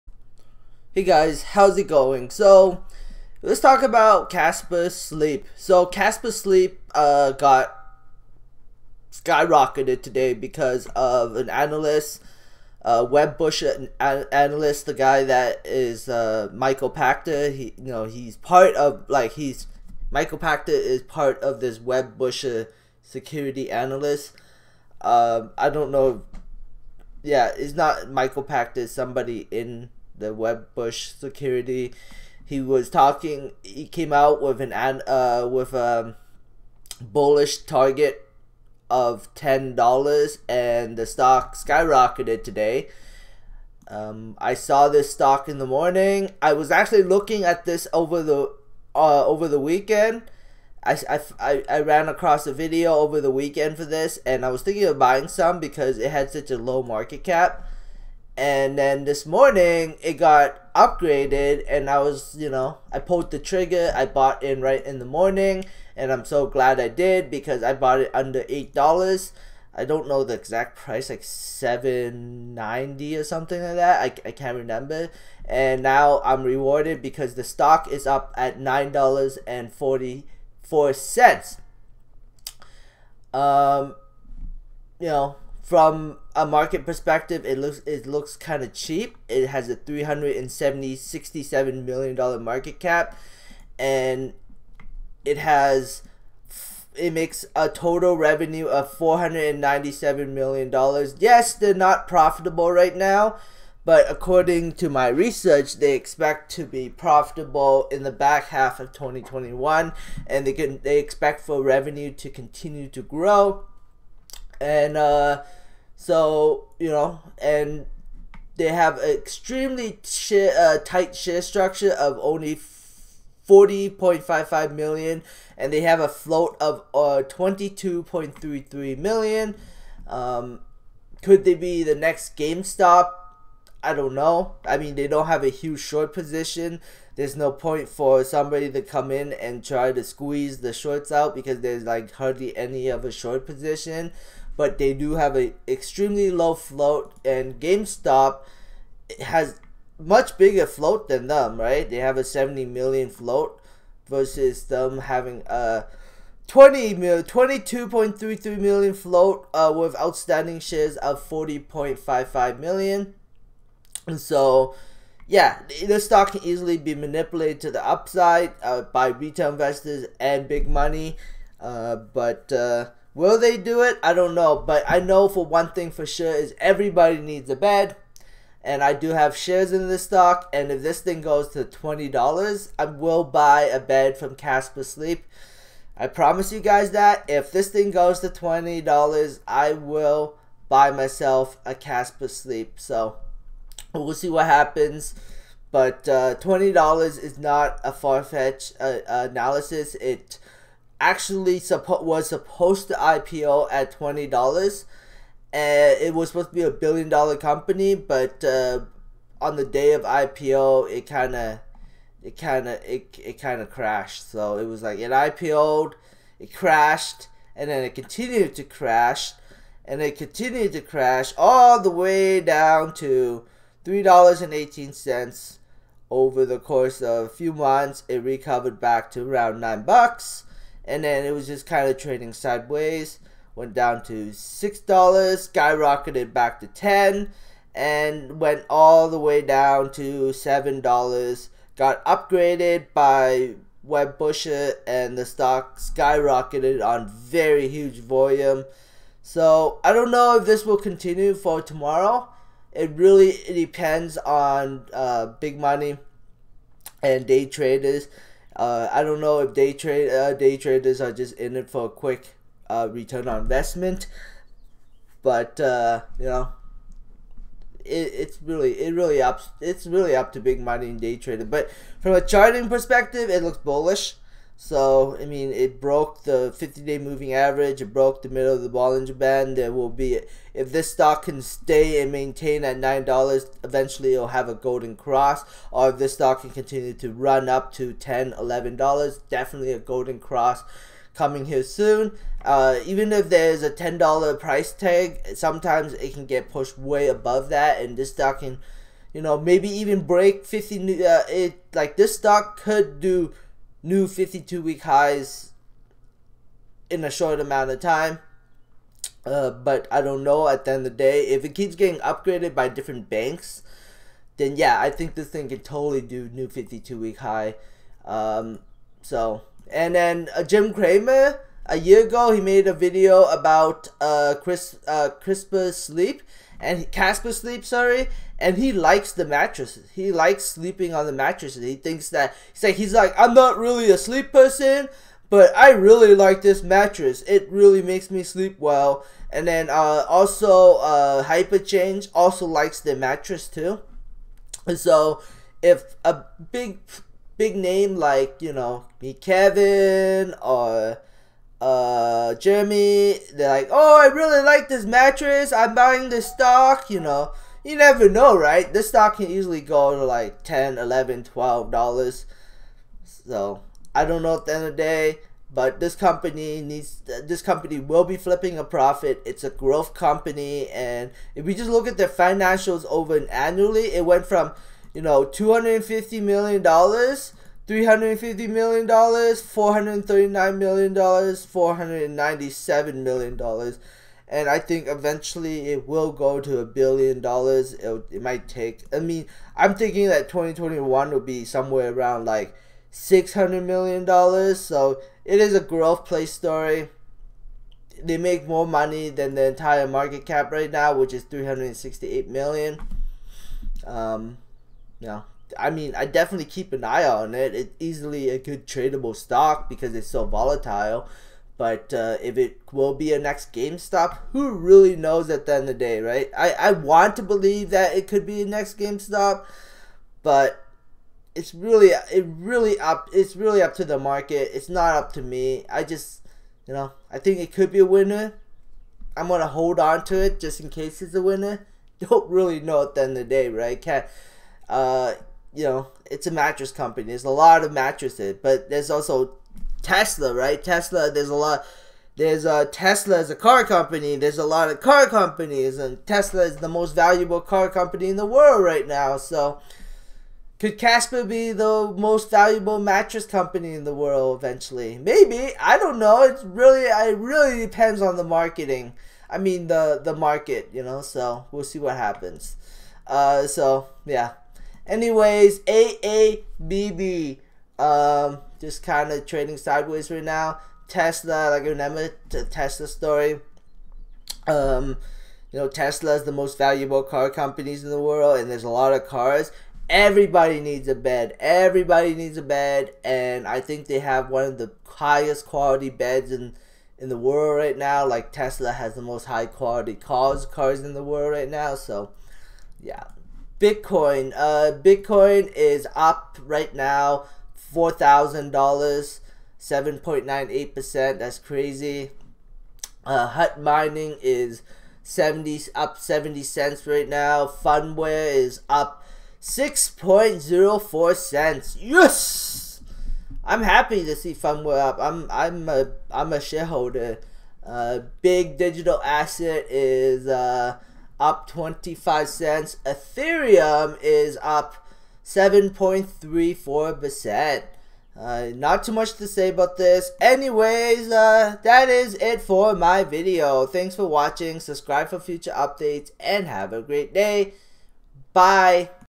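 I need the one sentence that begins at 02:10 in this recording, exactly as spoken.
Um, could they be the next GameStop?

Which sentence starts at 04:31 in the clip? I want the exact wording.
But from a charting perspective, it looks bullish.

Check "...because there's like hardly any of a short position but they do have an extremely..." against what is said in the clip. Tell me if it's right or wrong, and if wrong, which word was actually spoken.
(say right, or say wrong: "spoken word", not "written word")
right.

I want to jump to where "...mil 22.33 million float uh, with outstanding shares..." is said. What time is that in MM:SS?
02:36.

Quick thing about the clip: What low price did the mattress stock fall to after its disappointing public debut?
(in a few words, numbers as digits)
$3.18.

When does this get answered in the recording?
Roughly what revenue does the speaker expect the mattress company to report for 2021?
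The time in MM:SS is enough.
06:32.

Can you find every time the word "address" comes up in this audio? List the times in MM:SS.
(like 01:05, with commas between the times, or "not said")
not said.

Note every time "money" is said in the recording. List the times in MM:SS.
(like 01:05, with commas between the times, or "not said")
02:50, 04:15, 04:30, 06:38.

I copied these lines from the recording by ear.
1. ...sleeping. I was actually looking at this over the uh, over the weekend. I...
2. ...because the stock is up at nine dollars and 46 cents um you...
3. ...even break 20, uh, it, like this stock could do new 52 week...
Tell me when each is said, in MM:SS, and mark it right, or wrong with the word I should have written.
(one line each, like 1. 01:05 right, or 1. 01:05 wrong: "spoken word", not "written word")
1. 00:45 wrong: "morning", not "sleeping"
2. 01:17 wrong: "44", not "46"
3. 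04:59 wrong: "50", not "20".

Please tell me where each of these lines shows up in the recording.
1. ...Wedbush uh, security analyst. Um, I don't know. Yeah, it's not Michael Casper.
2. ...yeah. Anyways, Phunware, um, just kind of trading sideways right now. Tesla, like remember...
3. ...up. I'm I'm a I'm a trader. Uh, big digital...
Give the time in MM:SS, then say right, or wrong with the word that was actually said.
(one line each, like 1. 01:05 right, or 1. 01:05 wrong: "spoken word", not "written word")
1. 00:21 wrong: "Pachter", not "Casper"
2. 07:44 wrong: "AABB", not "Phunware"
3. 08:34 wrong: "shareholder", not "trader".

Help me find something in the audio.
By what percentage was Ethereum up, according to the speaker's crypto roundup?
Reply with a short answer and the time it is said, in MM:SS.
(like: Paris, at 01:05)
7.34%, at 08:45.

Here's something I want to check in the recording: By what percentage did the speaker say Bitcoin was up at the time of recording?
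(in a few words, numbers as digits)
7.98%.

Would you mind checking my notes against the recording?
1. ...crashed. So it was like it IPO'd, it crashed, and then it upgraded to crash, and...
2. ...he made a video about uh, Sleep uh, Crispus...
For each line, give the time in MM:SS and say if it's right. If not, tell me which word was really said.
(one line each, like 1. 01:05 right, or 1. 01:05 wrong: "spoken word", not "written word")
1. 03:33 wrong: "continued", not "upgraded"
2. 05:22 wrong: "Chris", not "Sleep".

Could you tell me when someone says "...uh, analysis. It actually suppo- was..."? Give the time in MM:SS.
03:18.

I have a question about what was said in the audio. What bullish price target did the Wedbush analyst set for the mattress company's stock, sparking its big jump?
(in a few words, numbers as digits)
$10.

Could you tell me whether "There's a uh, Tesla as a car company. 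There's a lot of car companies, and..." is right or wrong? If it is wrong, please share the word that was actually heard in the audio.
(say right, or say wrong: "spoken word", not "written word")
right.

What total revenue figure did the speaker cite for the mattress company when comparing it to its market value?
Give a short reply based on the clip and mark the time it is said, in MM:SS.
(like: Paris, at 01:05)
$497 million, at 01:38.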